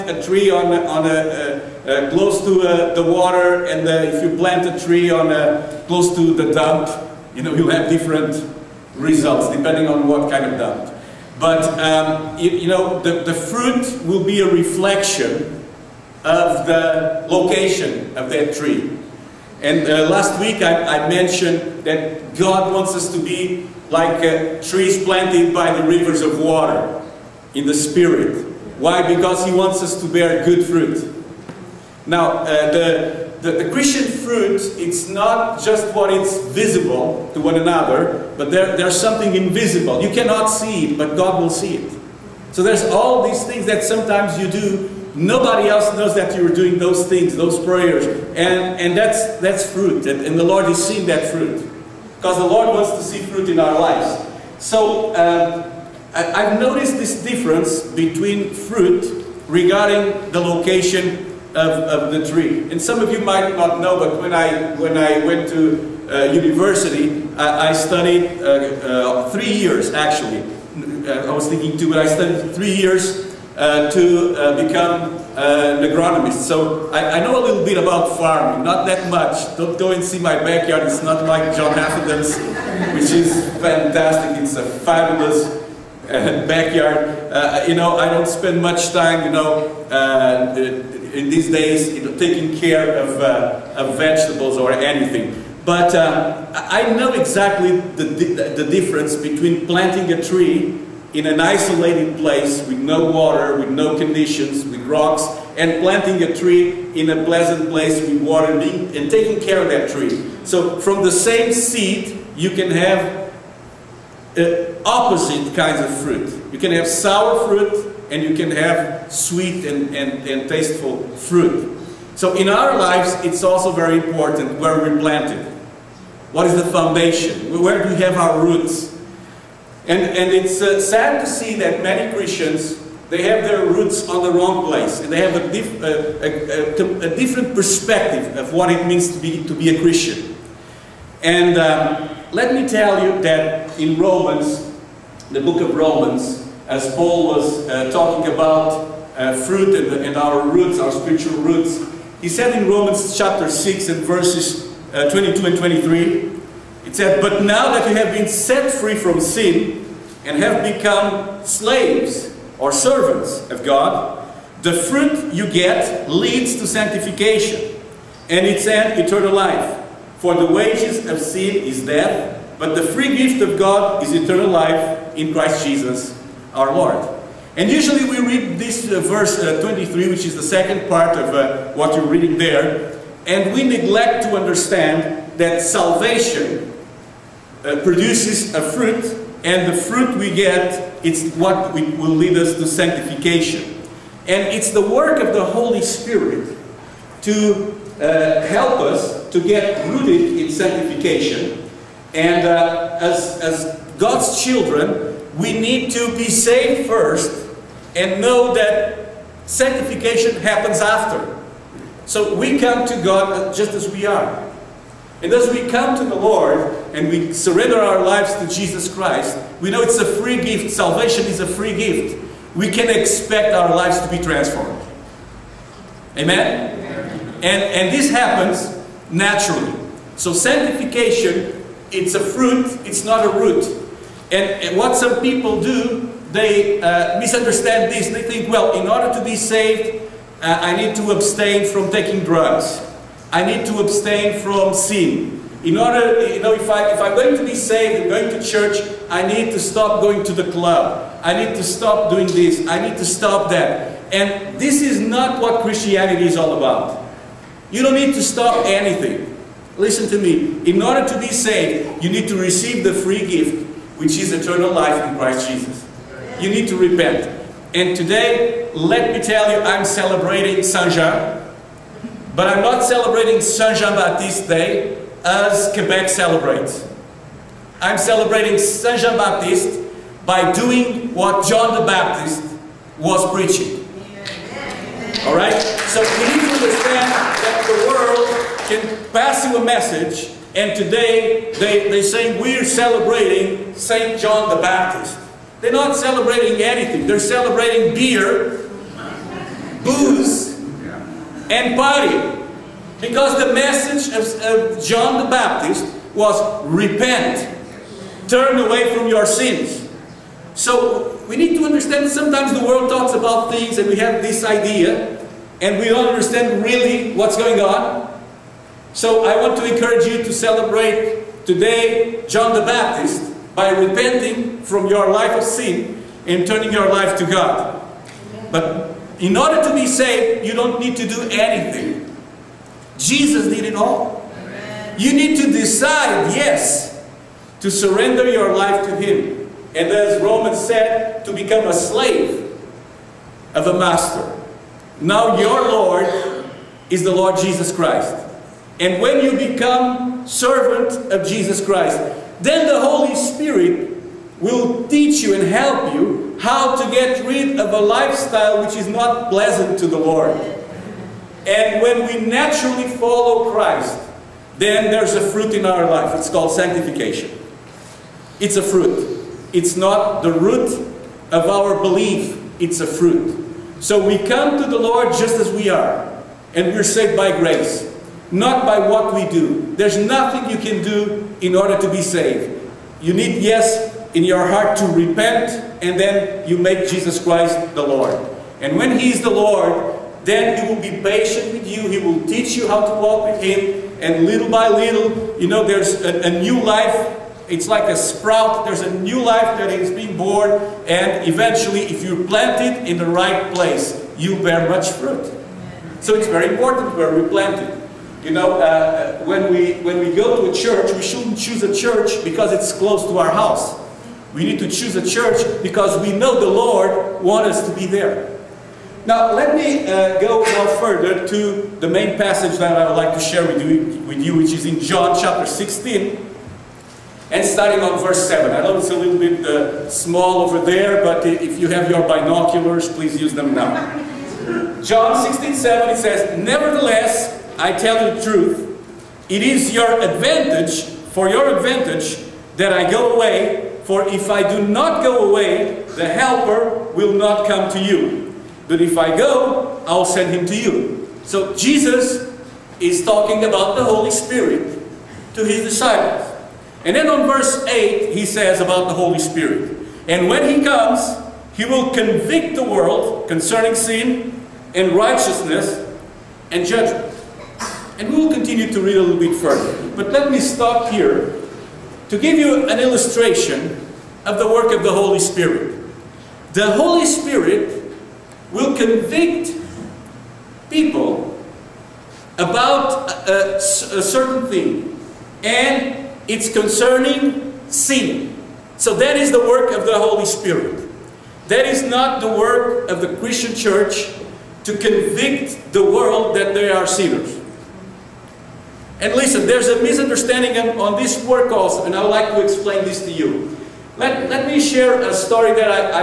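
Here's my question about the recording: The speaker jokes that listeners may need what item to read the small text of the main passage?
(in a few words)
binoculars.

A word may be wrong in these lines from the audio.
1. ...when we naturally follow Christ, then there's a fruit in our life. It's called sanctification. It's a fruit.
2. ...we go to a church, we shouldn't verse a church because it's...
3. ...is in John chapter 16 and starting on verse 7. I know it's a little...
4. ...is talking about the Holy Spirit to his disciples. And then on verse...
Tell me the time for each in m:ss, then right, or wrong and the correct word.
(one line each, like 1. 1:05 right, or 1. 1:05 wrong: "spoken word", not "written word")
1. 6:01 right
2. 6:49 wrong: "choose", not "verse"
3. 7:04 right
4. 7:32 right.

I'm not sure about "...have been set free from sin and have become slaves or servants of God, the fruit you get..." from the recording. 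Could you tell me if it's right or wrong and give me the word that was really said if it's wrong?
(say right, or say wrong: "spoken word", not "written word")
right.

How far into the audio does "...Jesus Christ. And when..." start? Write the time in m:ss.
5:47.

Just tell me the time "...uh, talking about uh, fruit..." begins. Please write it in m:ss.
2:27.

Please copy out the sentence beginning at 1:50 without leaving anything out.
So from the same seed, you can have uh, opposite kinds of fruit.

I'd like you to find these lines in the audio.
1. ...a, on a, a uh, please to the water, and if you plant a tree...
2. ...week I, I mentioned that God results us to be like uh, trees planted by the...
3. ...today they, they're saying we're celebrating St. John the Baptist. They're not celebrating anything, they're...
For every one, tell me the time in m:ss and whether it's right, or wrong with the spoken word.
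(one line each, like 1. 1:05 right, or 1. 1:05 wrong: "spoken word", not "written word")
1. 0:00 wrong: "close", not "please"
2. 0:20 wrong: "wants", not "results"
3. 4:50 right.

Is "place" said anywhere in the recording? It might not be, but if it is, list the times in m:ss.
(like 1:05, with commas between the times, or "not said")
1:42, 1:47, 2:14, 6:43.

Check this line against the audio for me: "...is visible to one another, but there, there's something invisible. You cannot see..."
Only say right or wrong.
right.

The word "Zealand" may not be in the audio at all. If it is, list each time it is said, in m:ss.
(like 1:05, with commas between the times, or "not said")
not said.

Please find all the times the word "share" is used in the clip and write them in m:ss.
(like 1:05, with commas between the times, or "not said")
7:03, 8:24.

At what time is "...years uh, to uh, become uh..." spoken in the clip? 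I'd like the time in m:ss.
1:12.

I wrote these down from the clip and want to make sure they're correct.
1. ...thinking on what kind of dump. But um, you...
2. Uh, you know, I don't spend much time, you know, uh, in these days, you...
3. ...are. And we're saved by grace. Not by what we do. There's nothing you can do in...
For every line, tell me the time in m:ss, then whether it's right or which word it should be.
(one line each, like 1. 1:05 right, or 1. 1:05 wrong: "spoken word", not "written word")
1. 0:09 wrong: "depending", not "thinking"
2. 1:27 right
3. 6:15 right.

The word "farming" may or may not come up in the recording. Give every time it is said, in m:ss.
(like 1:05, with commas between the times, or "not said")
1:18.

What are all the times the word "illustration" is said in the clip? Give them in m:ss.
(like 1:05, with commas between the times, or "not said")
7:52.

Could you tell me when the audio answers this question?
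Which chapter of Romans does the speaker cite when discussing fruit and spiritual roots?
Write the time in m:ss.
2:33.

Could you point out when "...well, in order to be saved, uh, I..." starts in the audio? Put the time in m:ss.
3:58.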